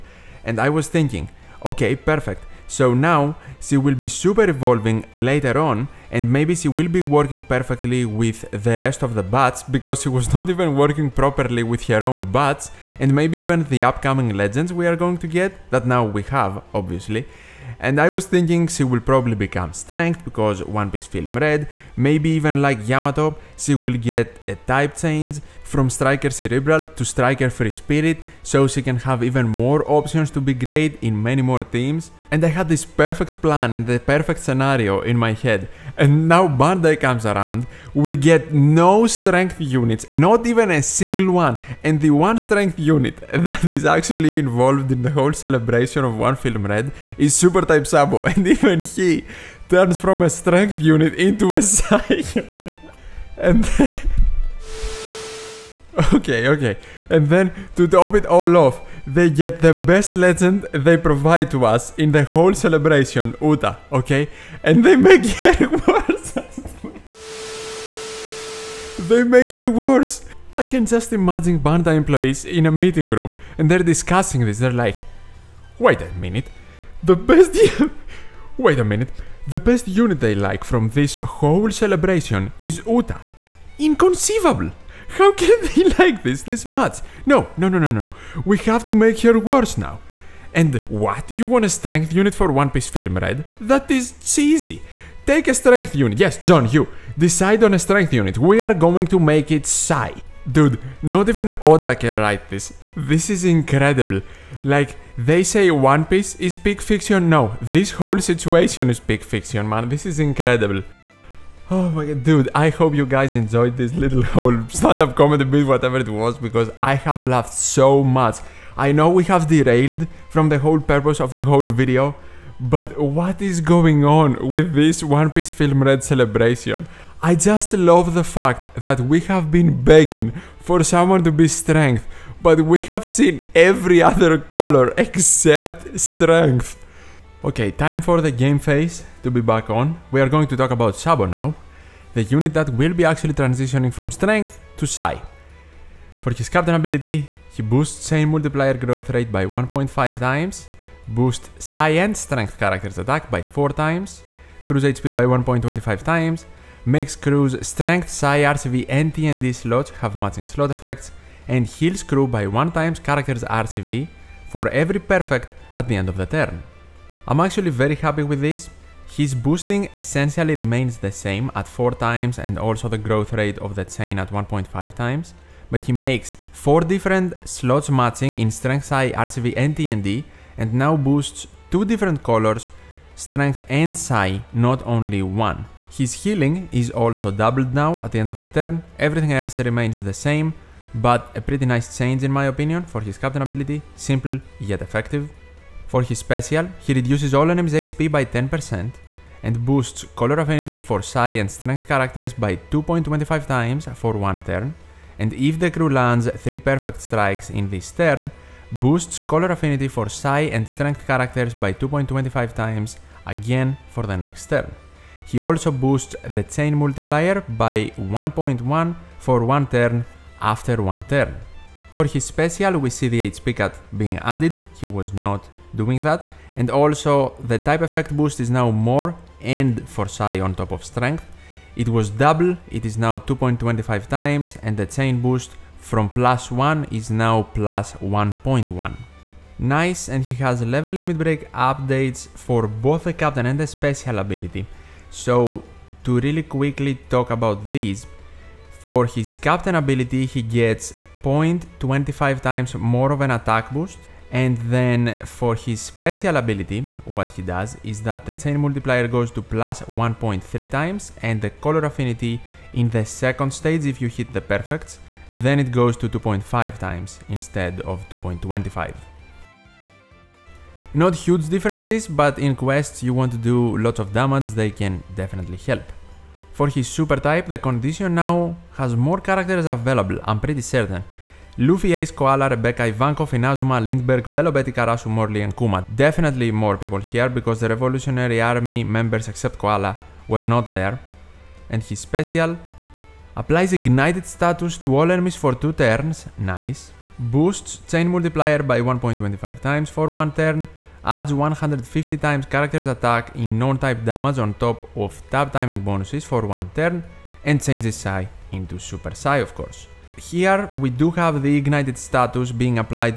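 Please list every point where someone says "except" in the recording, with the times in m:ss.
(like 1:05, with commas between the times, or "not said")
2:14, 4:49.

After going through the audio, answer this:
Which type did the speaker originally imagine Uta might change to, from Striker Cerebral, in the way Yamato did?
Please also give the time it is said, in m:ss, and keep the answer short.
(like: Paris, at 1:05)
Striker Free Spirit, at 0:27.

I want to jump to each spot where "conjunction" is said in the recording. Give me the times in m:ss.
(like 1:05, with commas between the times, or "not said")
not said.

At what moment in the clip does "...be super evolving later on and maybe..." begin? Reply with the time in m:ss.
0:03.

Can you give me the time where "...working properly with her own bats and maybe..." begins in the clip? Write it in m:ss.
0:10.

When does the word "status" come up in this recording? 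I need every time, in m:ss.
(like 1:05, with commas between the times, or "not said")
4:54, 5:11.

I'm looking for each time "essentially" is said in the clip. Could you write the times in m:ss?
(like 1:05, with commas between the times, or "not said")
2:49.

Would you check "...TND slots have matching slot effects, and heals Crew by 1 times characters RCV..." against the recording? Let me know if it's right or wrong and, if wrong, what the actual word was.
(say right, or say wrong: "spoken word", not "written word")
right.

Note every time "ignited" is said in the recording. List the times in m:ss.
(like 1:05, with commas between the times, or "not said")
4:53, 5:11.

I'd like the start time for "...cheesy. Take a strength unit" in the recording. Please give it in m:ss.
1:34.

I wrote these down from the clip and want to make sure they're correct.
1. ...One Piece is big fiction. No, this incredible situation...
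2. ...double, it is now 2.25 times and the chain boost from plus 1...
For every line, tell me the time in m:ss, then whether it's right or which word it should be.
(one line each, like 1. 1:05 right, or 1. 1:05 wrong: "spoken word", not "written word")
1. 1:45 wrong: "whole", not "incredible"
2. 3:52 right.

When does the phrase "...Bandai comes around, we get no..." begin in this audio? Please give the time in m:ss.
0:36.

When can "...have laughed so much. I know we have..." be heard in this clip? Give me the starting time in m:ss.
1:56.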